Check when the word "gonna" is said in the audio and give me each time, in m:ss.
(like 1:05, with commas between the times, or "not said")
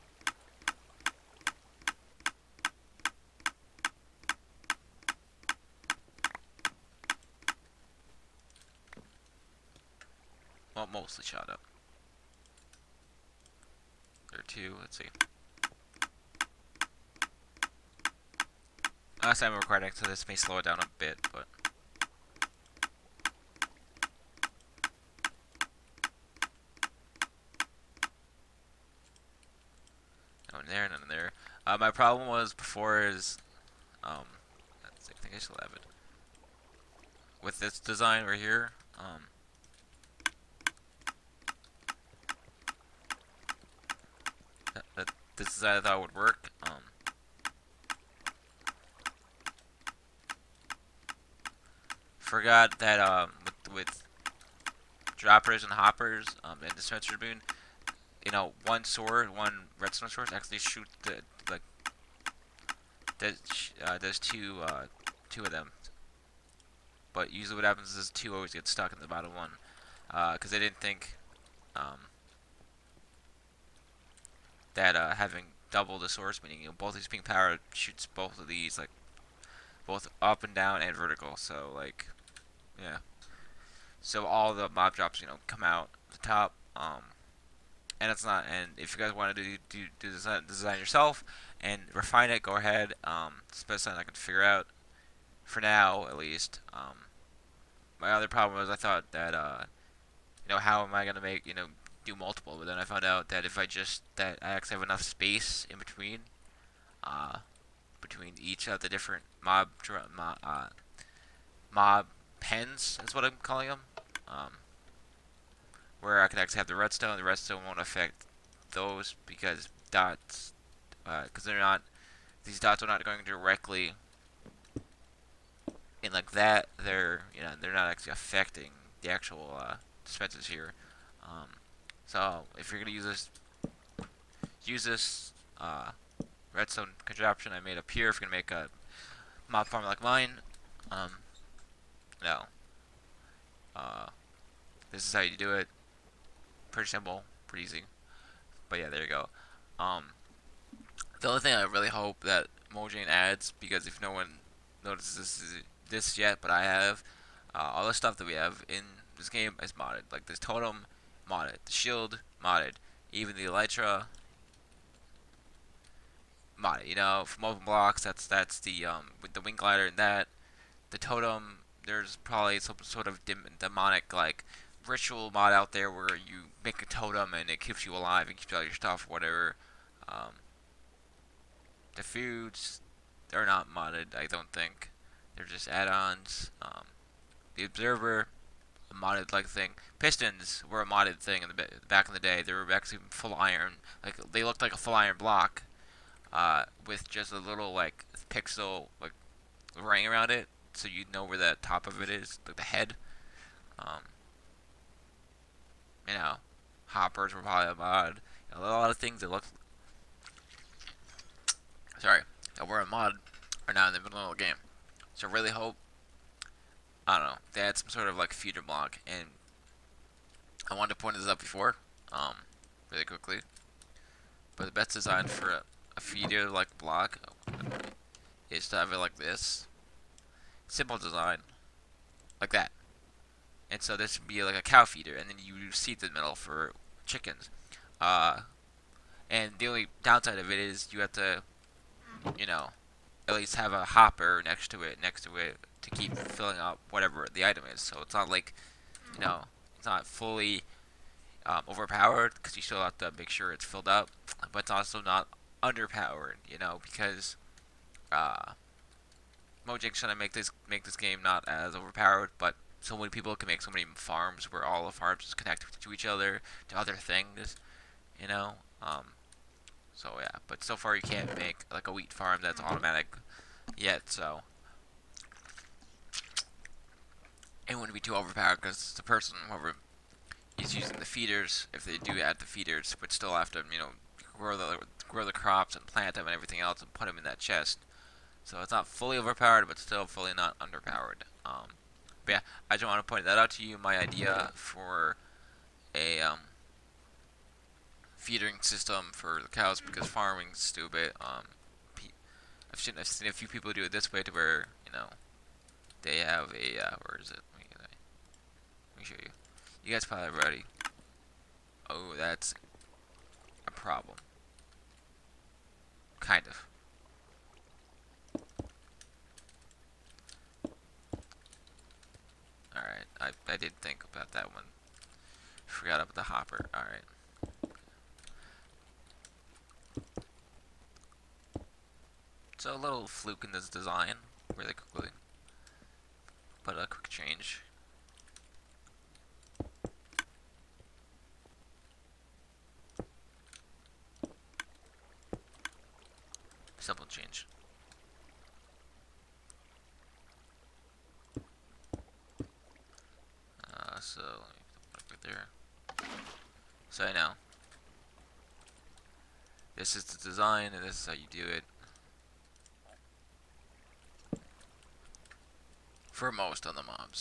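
1:41, 2:12, 2:18.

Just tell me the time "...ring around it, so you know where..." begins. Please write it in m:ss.
3:19.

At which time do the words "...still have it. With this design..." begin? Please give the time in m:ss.
0:35.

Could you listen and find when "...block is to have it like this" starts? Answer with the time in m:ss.
3:46.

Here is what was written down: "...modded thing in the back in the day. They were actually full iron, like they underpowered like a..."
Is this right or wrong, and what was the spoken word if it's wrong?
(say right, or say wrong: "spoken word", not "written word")
wrong: "looked", not "underpowered".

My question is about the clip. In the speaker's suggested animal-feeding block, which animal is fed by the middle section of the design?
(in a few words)
Chickens.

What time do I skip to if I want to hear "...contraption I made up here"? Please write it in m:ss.
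2:17.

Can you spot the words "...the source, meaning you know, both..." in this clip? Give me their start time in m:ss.
1:15.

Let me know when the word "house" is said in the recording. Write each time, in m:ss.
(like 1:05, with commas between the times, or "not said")
not said.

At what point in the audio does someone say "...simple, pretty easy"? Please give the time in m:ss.
2:26.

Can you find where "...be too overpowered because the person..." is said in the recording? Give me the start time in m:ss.
4:37.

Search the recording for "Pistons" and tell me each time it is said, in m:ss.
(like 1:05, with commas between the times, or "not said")
3:09.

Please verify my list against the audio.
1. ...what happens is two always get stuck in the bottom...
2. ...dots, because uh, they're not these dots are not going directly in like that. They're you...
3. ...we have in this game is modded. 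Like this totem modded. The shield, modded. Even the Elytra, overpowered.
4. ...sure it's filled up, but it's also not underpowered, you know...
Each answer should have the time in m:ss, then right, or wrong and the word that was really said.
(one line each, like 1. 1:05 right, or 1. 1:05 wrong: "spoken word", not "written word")
1. 1:07 right
2. 1:59 right
3. 2:38 wrong: "modded", not "overpowered"
4. 4:13 right.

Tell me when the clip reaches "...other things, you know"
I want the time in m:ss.
4:26.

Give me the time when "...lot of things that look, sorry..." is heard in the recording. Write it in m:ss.
3:28.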